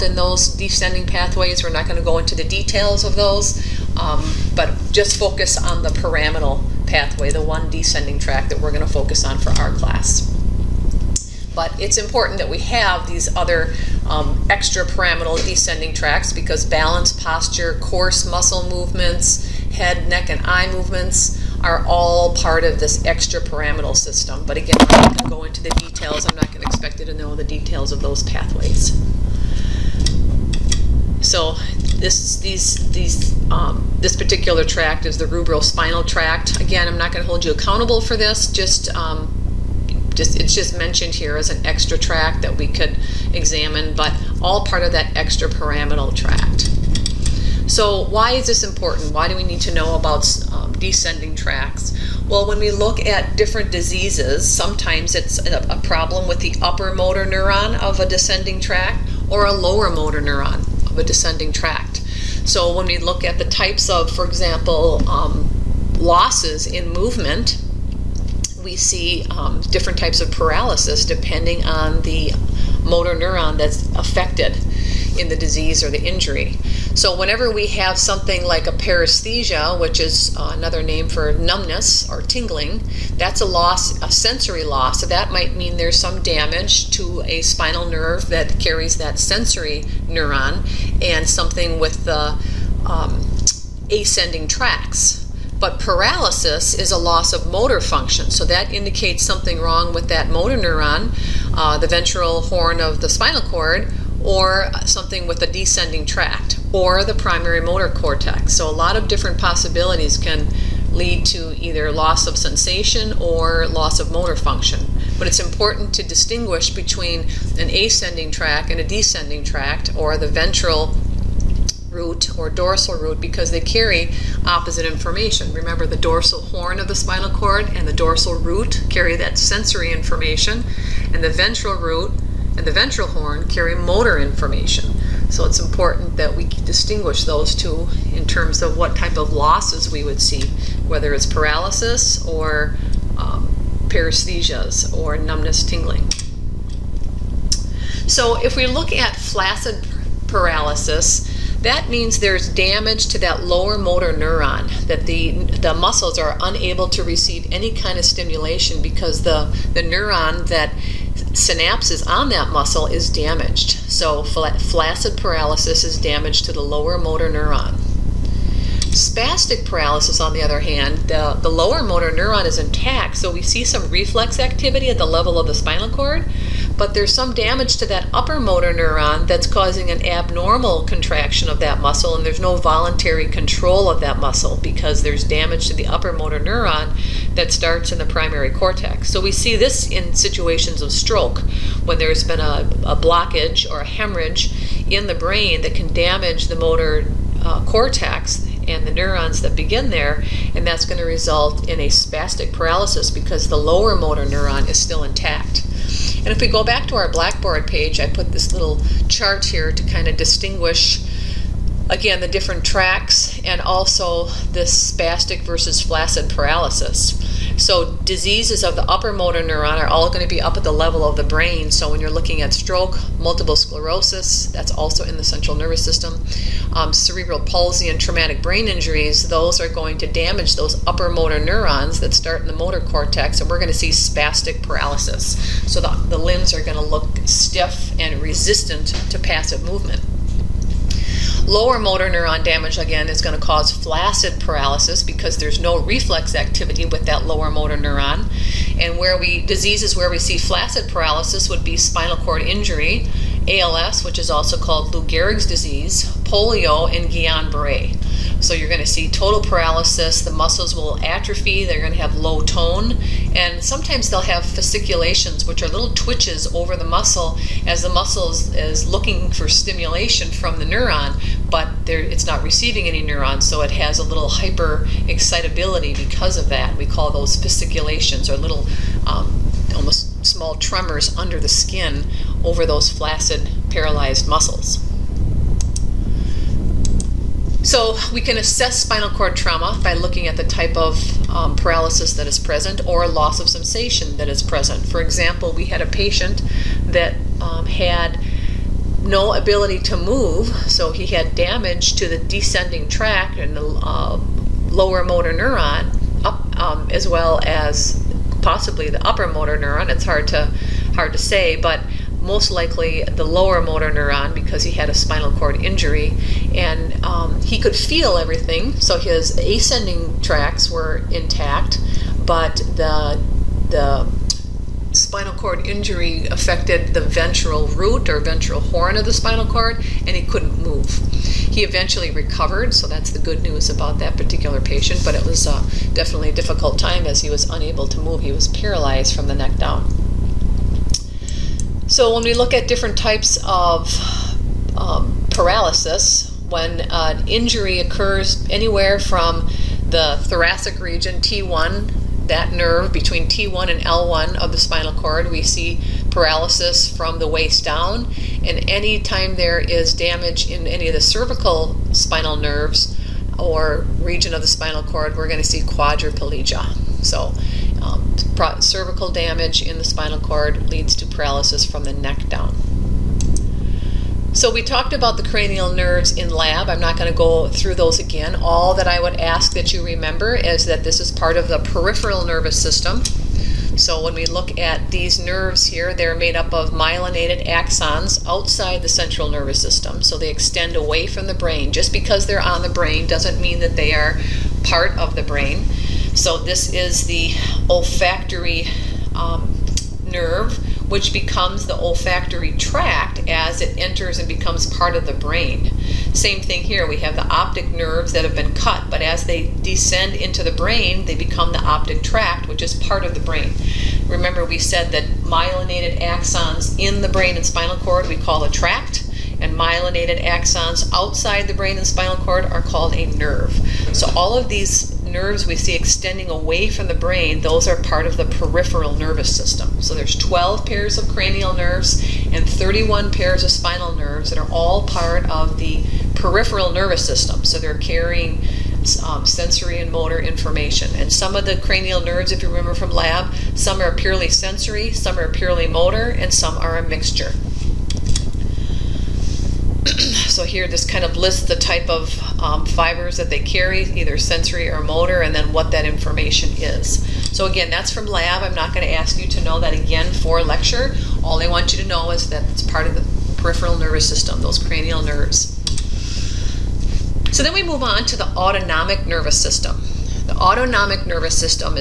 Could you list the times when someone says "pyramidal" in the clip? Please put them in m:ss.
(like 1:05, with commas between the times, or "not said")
0:05, 0:14, 0:23, 0:45.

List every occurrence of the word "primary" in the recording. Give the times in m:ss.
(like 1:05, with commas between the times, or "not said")
1:47, 3:08.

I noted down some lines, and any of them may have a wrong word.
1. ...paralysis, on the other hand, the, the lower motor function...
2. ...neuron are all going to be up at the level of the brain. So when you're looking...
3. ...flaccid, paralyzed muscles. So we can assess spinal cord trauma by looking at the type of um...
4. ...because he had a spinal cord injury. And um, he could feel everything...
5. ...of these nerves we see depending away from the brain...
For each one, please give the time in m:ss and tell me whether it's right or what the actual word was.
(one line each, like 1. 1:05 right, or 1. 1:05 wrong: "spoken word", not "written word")
1. 2:49 wrong: "neuron", not "function"
2. 3:39 right
3. 4:42 right
4. 5:14 right
5. 7:04 wrong: "extending", not "depending".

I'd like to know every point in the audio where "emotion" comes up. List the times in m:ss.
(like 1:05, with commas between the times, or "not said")
not said.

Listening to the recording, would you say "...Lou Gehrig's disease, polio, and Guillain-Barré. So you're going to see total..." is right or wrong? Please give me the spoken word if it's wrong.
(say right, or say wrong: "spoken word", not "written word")
right.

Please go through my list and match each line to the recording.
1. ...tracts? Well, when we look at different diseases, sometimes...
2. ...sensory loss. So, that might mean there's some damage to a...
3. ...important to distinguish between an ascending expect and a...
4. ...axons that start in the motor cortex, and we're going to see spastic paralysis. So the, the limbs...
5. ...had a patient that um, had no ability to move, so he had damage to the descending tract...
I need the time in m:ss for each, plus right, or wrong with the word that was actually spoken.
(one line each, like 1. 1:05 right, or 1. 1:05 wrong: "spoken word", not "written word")
1. 0:51 right
2. 1:24 right
3. 1:55 wrong: "tract", not "expect"
4. 3:51 wrong: "neurons", not "axons"
5. 4:55 right.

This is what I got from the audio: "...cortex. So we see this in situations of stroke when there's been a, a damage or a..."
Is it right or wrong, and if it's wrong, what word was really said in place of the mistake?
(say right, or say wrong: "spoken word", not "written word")
wrong: "blockage", not "damage".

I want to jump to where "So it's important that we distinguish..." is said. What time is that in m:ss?
2:15.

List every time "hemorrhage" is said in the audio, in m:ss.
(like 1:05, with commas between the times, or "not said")
3:13.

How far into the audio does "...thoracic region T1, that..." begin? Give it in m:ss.
5:50.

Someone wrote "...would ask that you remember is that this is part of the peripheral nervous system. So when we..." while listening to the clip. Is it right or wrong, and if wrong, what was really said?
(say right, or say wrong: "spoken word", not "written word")
right.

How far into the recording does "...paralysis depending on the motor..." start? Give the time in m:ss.
1:10.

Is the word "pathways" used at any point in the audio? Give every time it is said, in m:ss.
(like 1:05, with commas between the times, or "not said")
0:01, 0:06, 0:28.